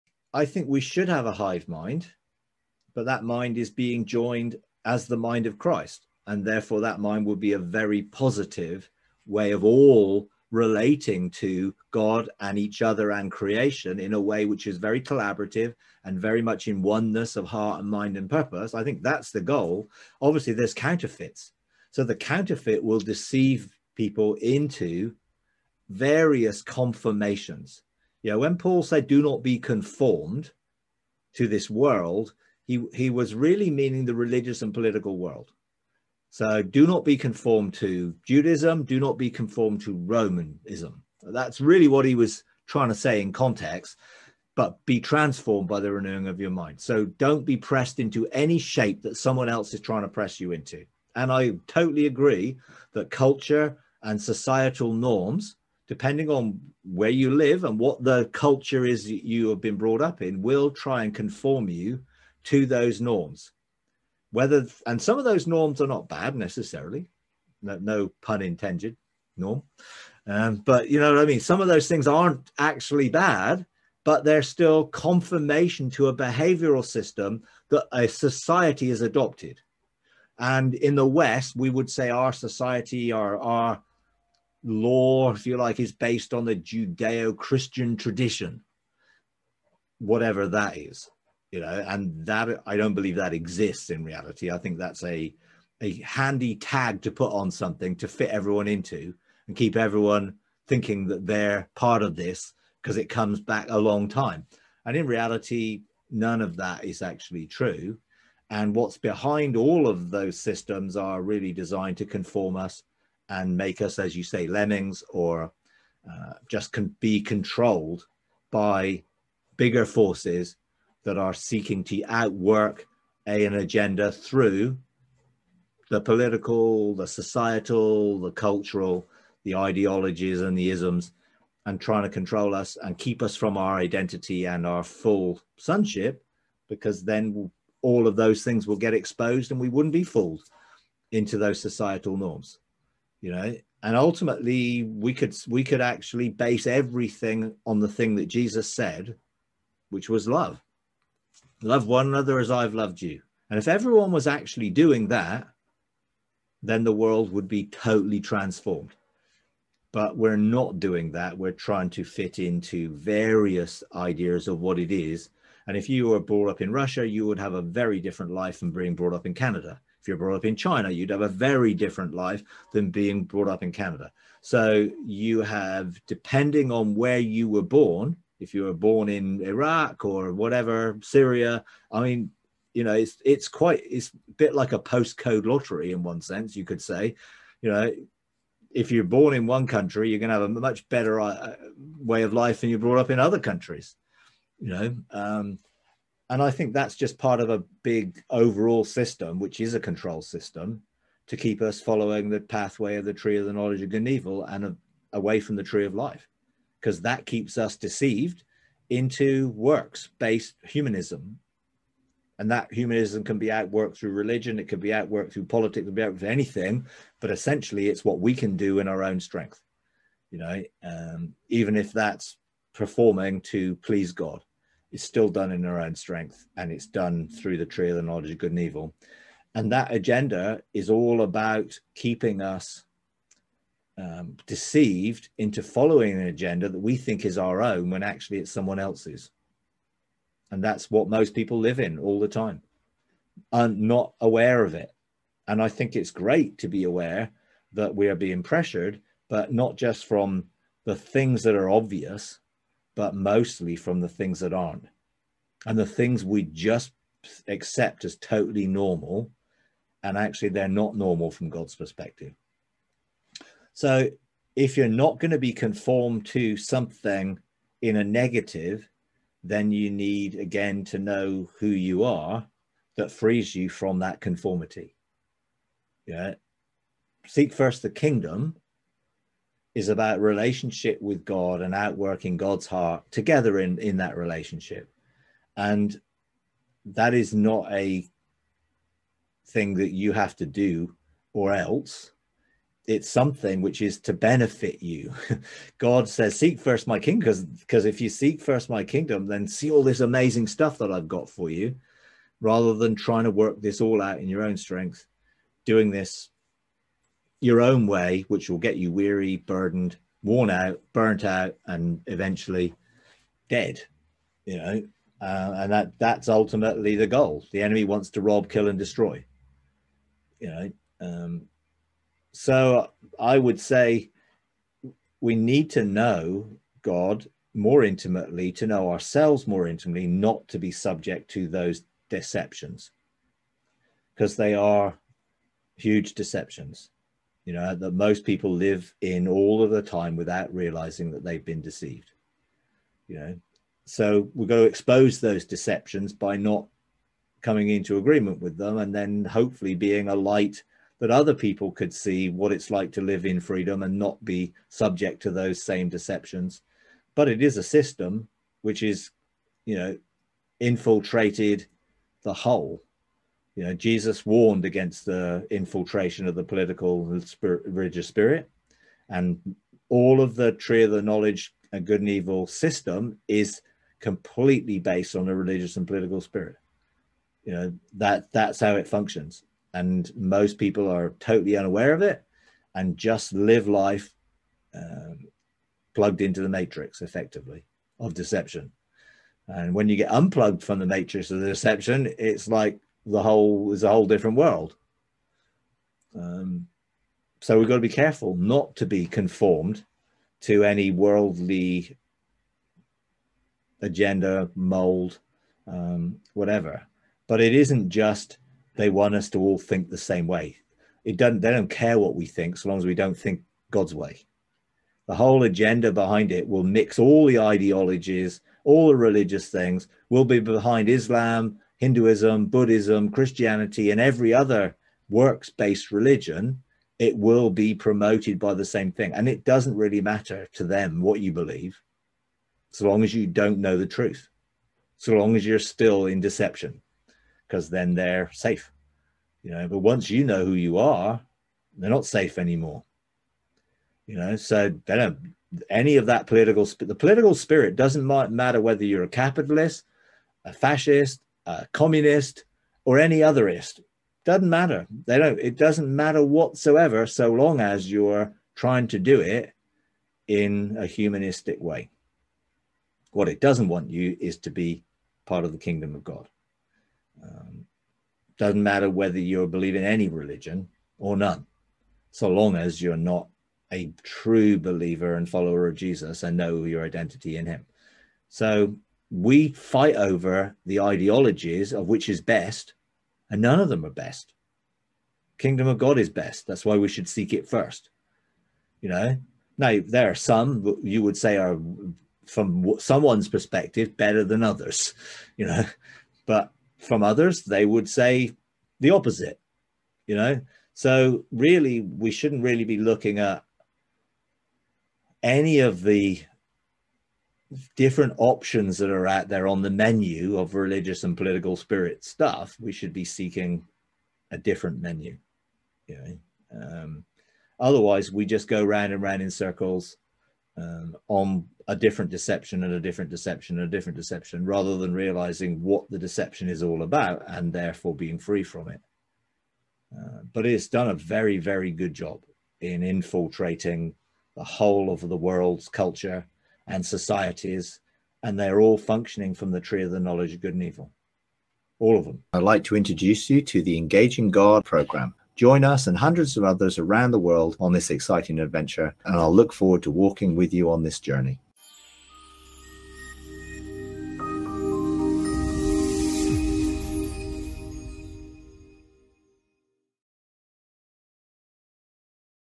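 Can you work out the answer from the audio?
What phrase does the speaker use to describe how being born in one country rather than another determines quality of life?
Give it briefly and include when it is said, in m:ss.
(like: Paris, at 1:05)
postcode lottery, at 3:04.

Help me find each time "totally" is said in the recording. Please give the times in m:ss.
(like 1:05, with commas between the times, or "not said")
0:51, 2:37, 4:18, 6:21.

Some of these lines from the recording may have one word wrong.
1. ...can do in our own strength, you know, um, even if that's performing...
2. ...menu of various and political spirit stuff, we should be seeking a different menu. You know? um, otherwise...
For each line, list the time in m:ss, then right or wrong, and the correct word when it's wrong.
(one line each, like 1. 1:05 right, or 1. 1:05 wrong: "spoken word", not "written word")
1. 3:38 right
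2. 8:29 wrong: "religious", not "various".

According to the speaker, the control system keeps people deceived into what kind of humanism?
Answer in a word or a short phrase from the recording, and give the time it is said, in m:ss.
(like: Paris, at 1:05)
works based humanism, at 3:29.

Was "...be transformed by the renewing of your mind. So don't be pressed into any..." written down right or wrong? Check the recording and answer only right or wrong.
right.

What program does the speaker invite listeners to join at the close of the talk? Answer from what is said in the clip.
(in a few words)
Engaging God.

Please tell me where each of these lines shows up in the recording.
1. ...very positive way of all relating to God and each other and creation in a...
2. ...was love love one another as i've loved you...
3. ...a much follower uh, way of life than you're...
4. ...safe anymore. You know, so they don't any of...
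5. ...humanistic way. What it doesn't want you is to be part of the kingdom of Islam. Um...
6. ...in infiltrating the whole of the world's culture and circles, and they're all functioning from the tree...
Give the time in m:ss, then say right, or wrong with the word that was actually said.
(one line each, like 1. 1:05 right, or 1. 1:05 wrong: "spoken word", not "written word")
1. 0:07 right
2. 2:30 right
3. 3:10 wrong: "better", not "follower"
4. 7:22 right
5. 7:40 wrong: "God", not "Islam"
6. 8:52 wrong: "societies", not "circles".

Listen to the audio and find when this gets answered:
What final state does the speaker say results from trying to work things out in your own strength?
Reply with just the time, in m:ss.
5:13.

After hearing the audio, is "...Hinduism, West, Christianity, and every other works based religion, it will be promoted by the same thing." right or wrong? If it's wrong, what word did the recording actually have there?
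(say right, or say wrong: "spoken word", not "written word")
wrong: "Buddhism", not "West".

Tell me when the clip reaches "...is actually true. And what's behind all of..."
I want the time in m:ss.
1:46.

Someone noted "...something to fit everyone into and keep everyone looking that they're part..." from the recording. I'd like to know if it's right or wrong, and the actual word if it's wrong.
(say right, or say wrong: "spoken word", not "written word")
wrong: "thinking", not "looking".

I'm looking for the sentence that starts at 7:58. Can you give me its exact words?
So we fight over the ideologies of which is best, and none of them are best.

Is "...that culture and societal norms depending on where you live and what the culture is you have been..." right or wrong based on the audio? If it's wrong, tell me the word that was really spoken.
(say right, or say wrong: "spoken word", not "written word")
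right.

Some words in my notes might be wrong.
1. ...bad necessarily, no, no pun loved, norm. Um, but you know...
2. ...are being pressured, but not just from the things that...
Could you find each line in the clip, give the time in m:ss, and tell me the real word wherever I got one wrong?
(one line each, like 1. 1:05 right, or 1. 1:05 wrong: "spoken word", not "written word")
1. 1:06 wrong: "intended", not "loved"
2. 4:08 right.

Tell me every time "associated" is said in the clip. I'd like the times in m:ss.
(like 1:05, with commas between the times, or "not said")
not said.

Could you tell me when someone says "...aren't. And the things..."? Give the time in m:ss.
4:14.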